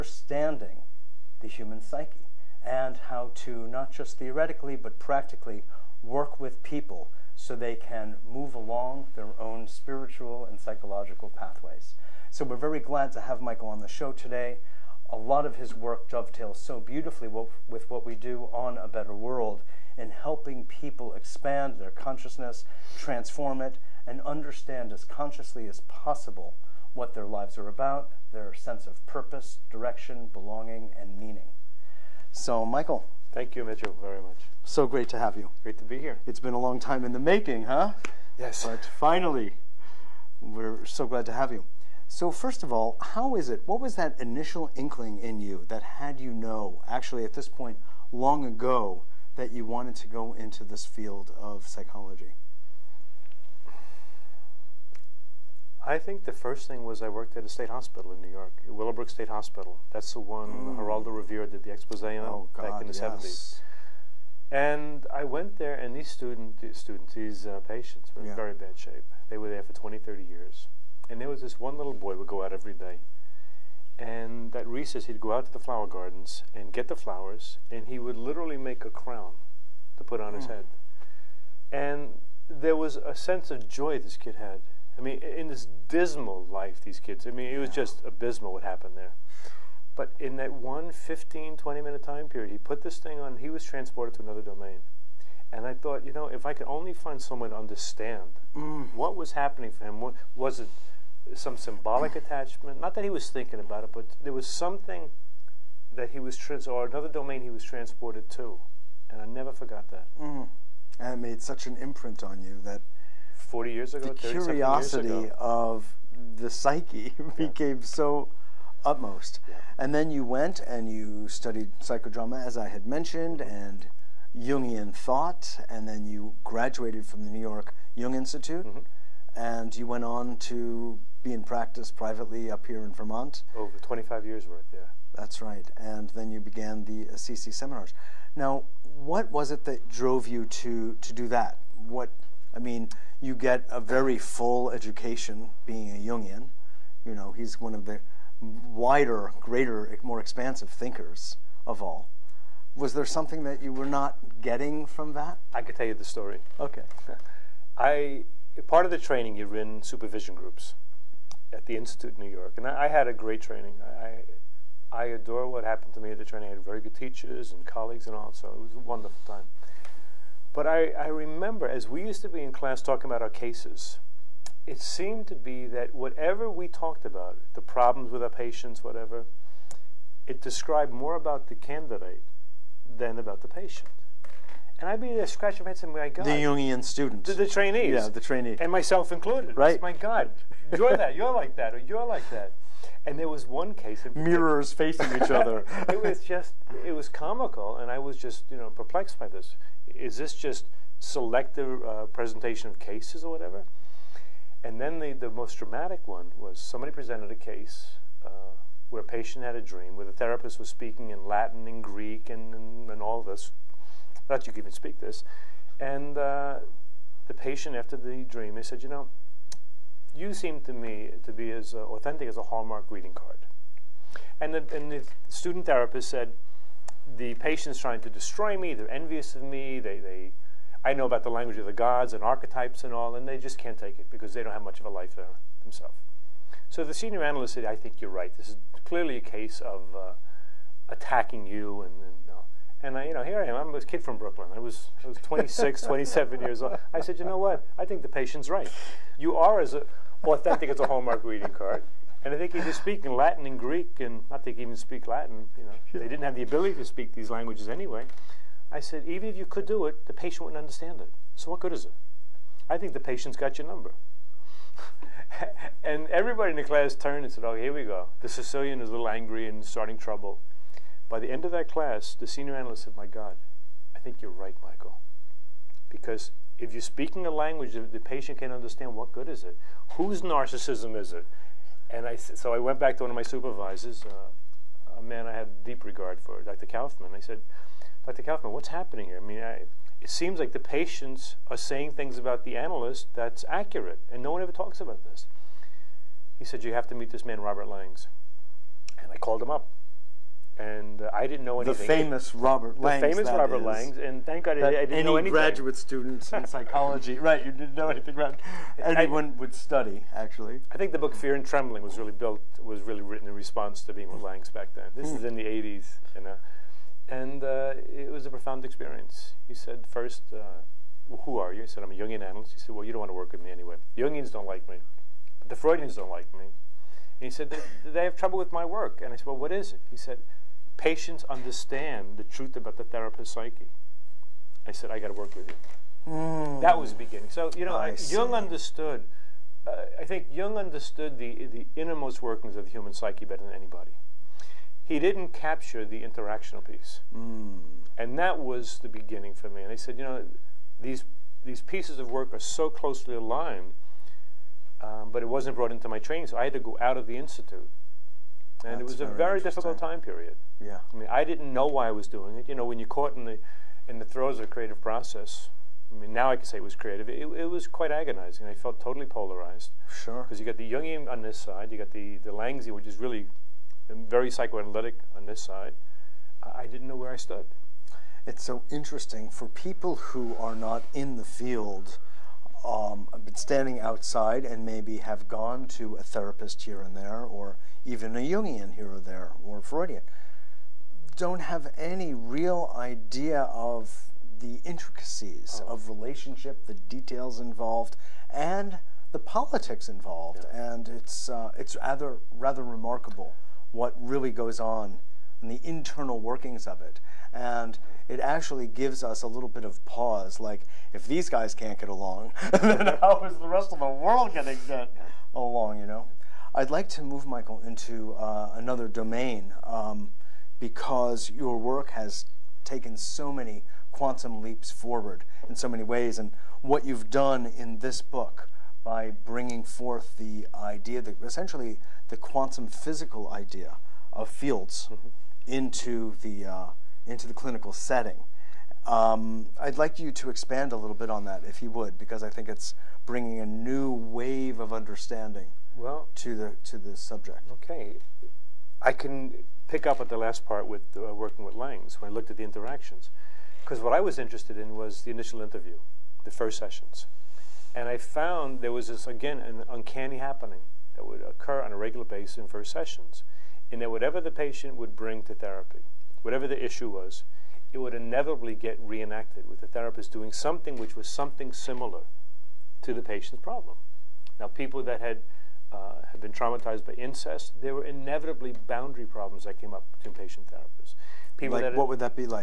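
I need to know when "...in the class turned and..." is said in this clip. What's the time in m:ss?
4:26.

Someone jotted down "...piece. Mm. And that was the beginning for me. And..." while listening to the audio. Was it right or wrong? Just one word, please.
right.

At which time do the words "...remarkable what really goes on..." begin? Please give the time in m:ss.
6:42.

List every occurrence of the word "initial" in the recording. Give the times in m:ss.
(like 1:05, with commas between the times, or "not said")
0:44, 7:35.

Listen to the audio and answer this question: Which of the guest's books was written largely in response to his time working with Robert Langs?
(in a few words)
Fear and Trembling.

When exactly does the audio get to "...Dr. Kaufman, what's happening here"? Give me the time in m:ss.
4:48.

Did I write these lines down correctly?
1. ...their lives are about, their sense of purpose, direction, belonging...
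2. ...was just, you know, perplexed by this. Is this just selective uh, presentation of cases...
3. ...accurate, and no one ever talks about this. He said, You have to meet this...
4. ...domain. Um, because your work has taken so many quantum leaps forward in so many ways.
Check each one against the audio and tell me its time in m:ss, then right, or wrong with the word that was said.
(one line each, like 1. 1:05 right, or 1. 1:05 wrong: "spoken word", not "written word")
1. 0:27 right
2. 3:17 right
3. 4:53 right
4. 6:58 right.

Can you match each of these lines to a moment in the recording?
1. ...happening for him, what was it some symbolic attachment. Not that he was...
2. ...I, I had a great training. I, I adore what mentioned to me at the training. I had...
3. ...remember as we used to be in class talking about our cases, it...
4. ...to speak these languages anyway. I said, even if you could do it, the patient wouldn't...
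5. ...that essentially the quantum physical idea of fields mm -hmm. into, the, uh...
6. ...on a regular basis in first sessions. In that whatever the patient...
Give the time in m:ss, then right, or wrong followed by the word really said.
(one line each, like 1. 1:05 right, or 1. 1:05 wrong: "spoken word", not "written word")
1. 1:39 right
2. 2:42 wrong: "happened", not "mentioned"
3. 2:51 right
4. 4:16 right
5. 7:11 right
6. 7:41 right.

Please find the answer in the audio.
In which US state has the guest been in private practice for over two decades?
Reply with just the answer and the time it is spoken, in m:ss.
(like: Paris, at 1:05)
Vermont, at 2:12.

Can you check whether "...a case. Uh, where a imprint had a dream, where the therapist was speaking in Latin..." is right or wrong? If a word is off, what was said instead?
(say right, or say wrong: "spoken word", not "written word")
wrong: "patient", not "imprint".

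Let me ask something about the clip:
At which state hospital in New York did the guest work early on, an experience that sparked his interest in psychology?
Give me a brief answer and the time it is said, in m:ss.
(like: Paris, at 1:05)
Willowbrook State Hospital, at 0:58.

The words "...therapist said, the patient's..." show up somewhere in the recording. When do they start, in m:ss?
3:45.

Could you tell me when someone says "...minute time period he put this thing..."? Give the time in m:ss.
1:31.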